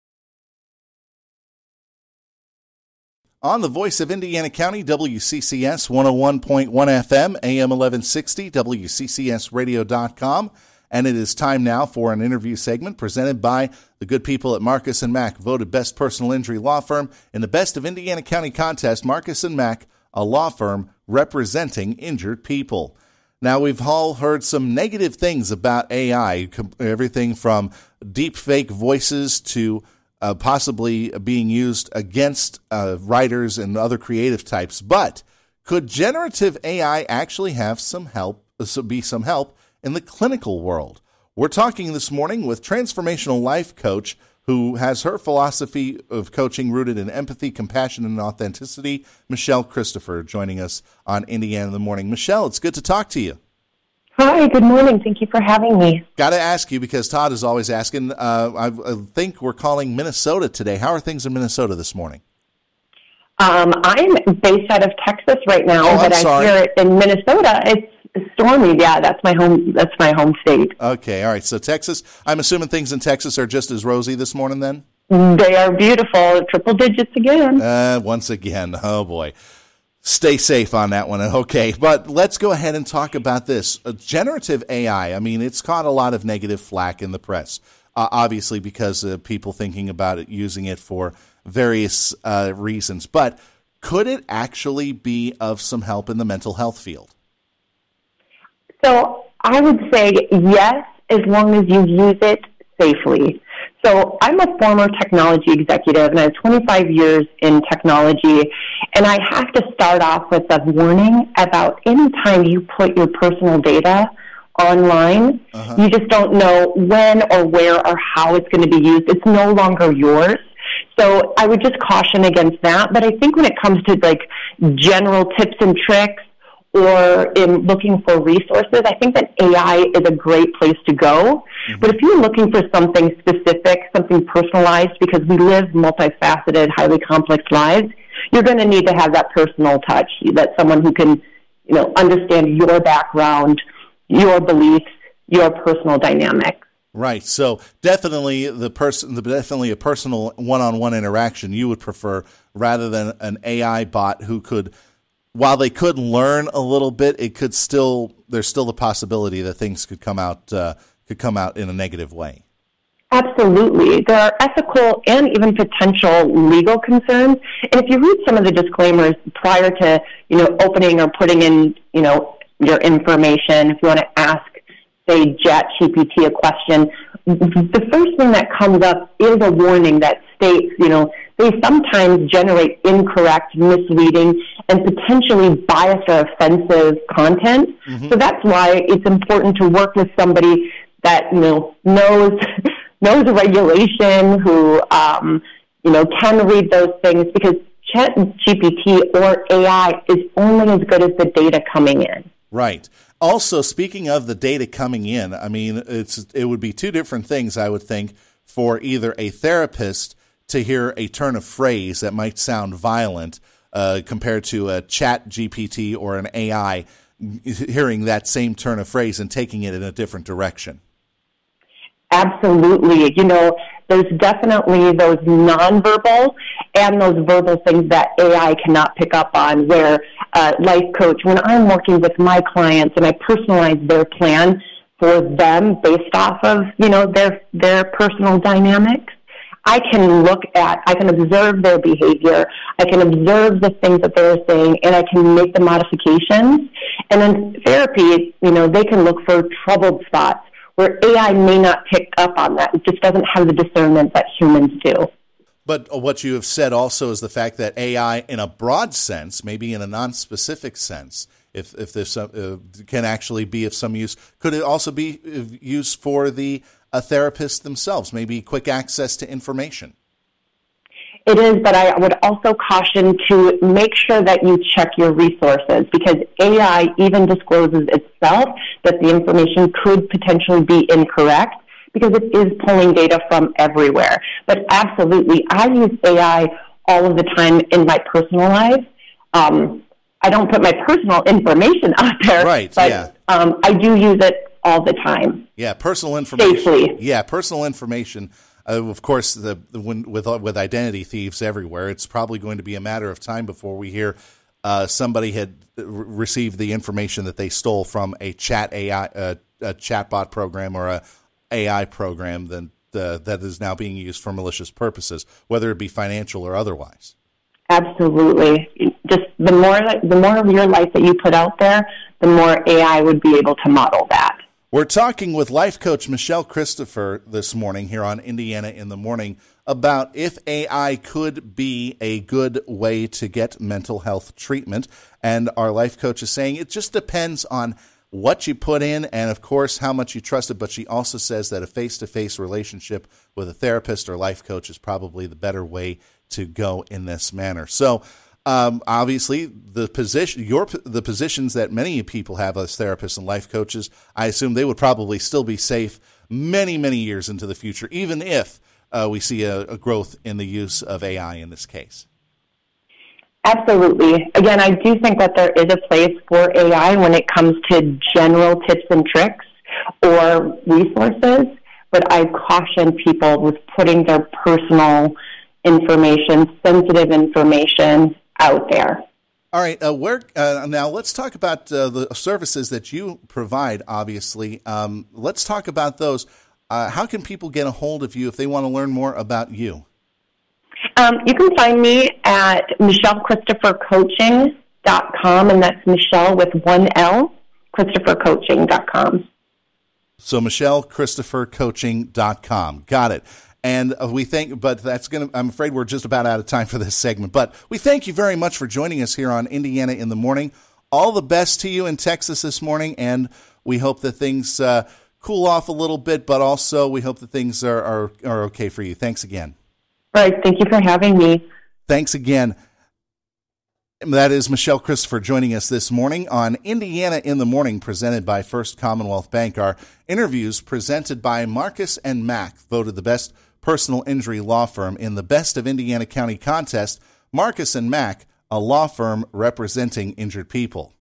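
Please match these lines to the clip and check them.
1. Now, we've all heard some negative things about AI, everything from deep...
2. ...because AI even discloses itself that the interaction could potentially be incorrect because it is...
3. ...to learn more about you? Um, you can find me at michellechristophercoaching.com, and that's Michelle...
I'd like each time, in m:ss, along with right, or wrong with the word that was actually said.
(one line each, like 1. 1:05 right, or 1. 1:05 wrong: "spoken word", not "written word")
1. 0:23 right
2. 4:35 wrong: "information", not "interaction"
3. 6:28 right.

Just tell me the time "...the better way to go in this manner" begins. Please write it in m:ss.
5:45.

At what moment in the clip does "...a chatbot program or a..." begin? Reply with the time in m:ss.
5:09.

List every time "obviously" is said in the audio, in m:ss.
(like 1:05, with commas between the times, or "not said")
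1:28, 5:48, 6:23.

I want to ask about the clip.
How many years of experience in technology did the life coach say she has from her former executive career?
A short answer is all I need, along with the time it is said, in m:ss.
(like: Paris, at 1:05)
25, at 1:46.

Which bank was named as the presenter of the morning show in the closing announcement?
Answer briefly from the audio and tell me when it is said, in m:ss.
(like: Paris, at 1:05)
First Commonwealth Bank, at 7:08.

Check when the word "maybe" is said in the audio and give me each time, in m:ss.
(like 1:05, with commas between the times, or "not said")
4:19, 4:28.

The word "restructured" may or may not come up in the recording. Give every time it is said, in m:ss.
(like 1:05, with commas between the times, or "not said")
not said.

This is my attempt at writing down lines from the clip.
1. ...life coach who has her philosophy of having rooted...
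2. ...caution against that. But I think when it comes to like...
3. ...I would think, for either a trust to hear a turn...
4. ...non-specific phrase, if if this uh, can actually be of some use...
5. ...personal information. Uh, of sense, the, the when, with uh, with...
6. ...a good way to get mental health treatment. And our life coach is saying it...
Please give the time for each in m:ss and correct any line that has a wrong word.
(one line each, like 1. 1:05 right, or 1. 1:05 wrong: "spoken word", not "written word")
1. 0:43 wrong: "coaching", not "having"
2. 2:01 right
3. 3:27 wrong: "therapist", not "trust"
4. 4:19 wrong: "sense", not "phrase"
5. 4:57 wrong: "course", not "sense"
6. 5:31 right.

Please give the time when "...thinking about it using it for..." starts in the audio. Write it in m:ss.
1:29.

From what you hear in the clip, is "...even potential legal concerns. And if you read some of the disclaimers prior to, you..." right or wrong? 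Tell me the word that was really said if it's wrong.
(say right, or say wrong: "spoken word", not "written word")
right.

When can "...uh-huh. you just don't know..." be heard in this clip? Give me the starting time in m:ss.
1:55.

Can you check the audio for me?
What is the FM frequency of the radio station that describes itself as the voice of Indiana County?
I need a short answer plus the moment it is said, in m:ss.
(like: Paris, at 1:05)
101.1, at 0:05.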